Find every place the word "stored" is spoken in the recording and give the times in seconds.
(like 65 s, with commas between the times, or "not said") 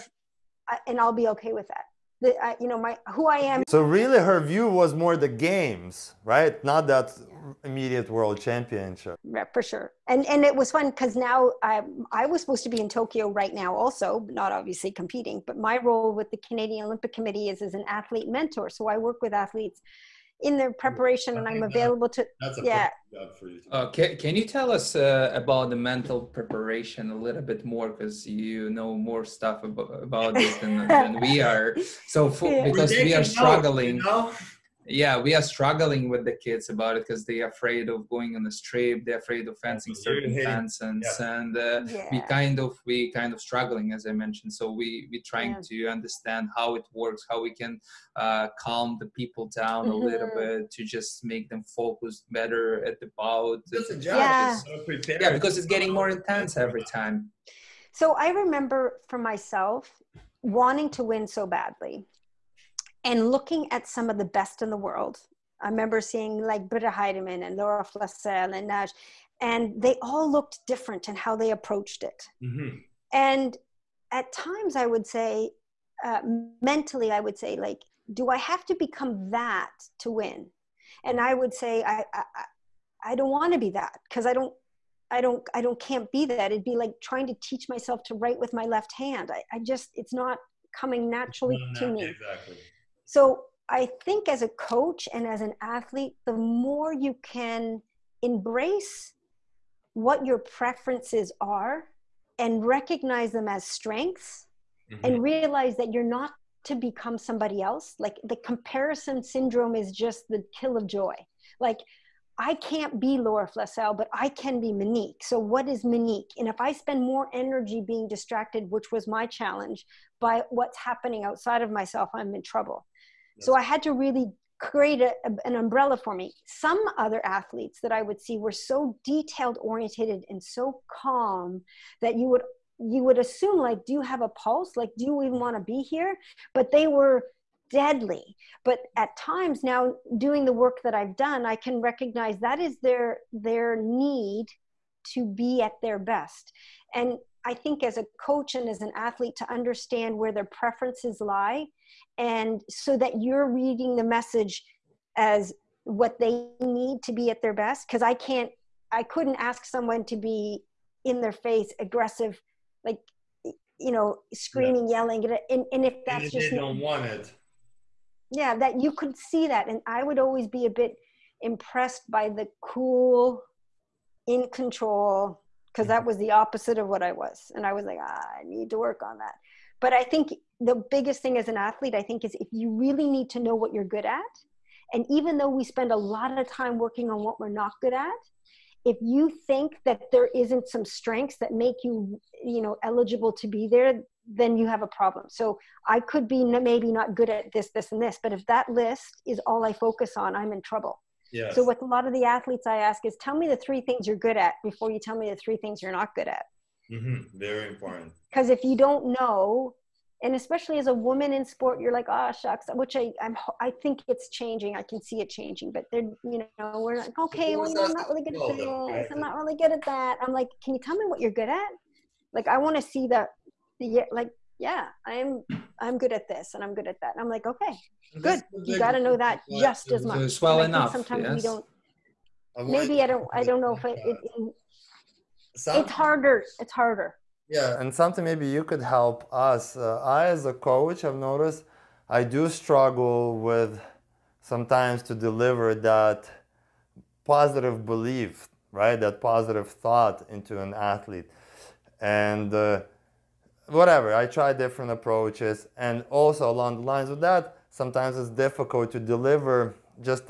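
not said.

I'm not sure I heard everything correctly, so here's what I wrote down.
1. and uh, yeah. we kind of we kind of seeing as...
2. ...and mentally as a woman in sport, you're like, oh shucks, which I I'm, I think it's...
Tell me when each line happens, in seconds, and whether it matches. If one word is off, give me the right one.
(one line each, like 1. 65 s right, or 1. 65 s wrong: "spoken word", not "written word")
1. 41 s wrong: "struggling", not "seeing"
2. 210 s wrong: "especially", not "mentally".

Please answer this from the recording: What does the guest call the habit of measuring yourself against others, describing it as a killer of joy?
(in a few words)
Comparison syndrome.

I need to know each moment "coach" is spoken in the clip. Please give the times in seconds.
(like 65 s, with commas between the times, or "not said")
94 s, 148 s, 240 s.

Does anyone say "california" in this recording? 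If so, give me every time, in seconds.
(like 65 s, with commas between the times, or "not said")
not said.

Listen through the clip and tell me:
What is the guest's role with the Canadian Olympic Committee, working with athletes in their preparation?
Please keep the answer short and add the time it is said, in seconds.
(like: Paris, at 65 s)
Athlete mentor, at 17 s.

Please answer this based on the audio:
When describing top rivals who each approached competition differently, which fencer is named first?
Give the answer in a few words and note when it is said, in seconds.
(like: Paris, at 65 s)
Britta Heidemann, at 66 s.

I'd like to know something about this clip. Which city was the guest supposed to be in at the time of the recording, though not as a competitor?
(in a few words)
Tokyo.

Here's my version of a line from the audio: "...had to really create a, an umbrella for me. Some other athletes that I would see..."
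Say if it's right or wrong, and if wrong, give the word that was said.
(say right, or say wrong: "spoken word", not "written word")
right.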